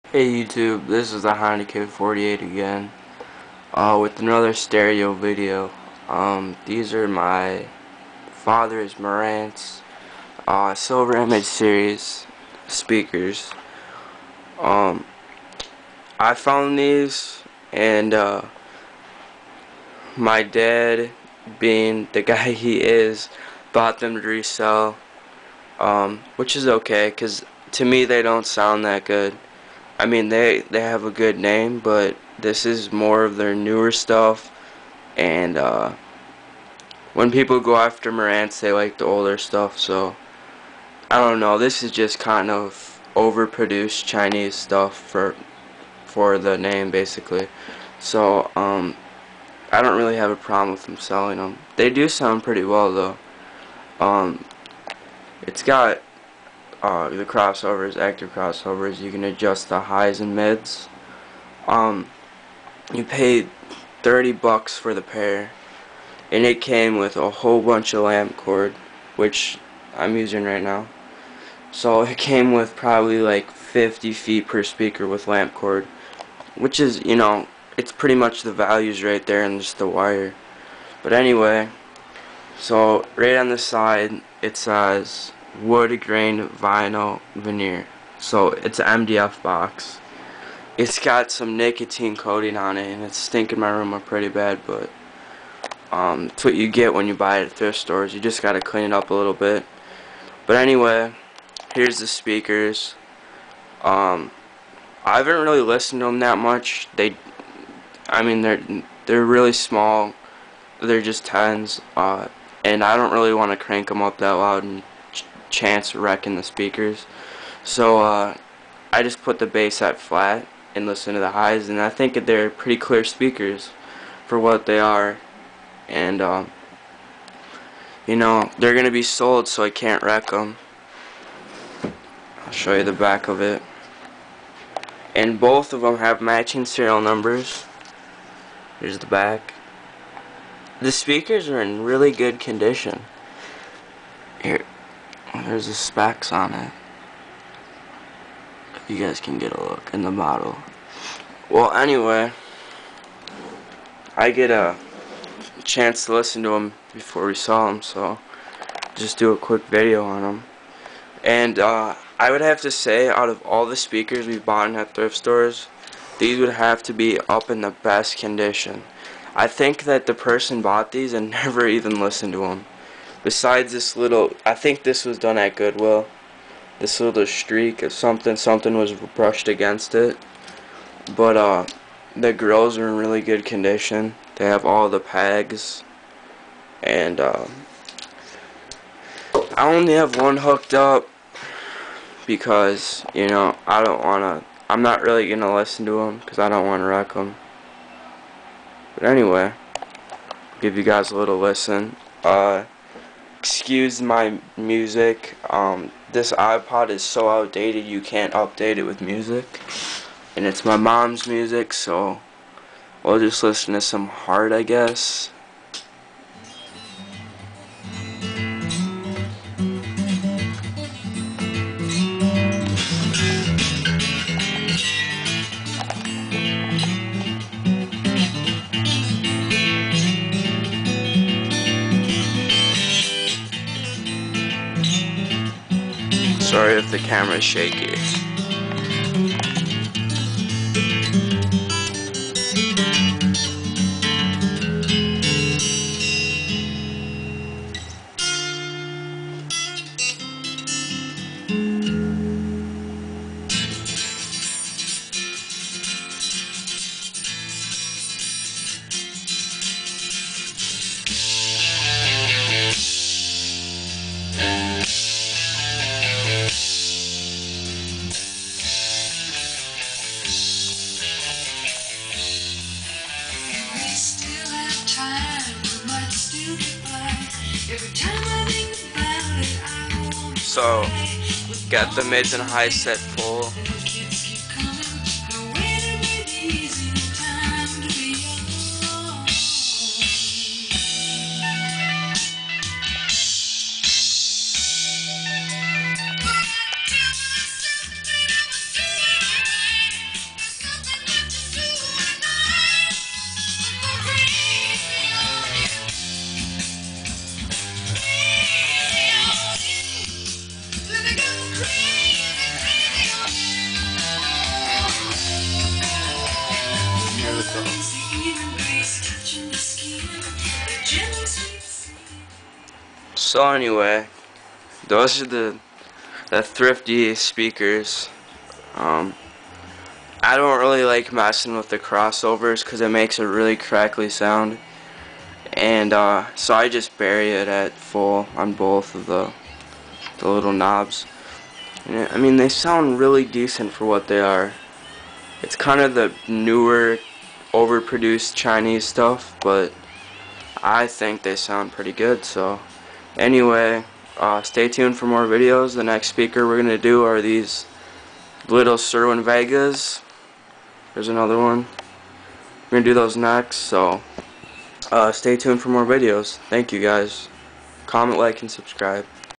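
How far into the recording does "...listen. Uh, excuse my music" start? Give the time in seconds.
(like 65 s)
201 s.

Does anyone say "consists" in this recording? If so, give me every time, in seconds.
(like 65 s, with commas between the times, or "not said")
not said.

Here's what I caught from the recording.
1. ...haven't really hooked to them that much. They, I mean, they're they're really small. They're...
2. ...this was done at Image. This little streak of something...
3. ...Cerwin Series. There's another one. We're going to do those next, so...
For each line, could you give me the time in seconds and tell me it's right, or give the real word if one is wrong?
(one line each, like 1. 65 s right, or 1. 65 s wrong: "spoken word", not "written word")
1. 105 s wrong: "listened", not "hooked"
2. 174 s wrong: "Goodwill", not "Image"
3. 358 s wrong: "Vegas", not "Series".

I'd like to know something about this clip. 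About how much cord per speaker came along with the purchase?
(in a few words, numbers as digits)
50 feet.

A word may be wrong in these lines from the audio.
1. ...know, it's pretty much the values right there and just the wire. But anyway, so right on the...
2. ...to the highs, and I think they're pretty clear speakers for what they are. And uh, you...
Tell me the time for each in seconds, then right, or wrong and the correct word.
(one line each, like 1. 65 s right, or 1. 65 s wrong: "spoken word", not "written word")
1. 77 s right
2. 121 s right.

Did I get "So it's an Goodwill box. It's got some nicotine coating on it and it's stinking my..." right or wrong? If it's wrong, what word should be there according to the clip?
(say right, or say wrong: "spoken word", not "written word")
wrong: "MDF", not "Goodwill".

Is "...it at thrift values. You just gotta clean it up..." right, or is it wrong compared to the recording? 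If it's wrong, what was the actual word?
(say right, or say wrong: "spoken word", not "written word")
wrong: "stores", not "values".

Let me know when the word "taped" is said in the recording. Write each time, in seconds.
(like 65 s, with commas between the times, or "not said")
not said.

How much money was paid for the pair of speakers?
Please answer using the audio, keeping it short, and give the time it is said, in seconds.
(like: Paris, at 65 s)
30 bucks, at 64 s.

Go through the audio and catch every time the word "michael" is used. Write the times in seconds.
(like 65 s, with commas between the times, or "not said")
not said.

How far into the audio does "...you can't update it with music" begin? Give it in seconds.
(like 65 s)
207 s.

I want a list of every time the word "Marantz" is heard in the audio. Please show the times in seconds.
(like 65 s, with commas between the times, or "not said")
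8 s, 38 s.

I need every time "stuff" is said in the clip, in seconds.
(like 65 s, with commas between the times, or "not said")
33 s, 39 s, 44 s, 348 s.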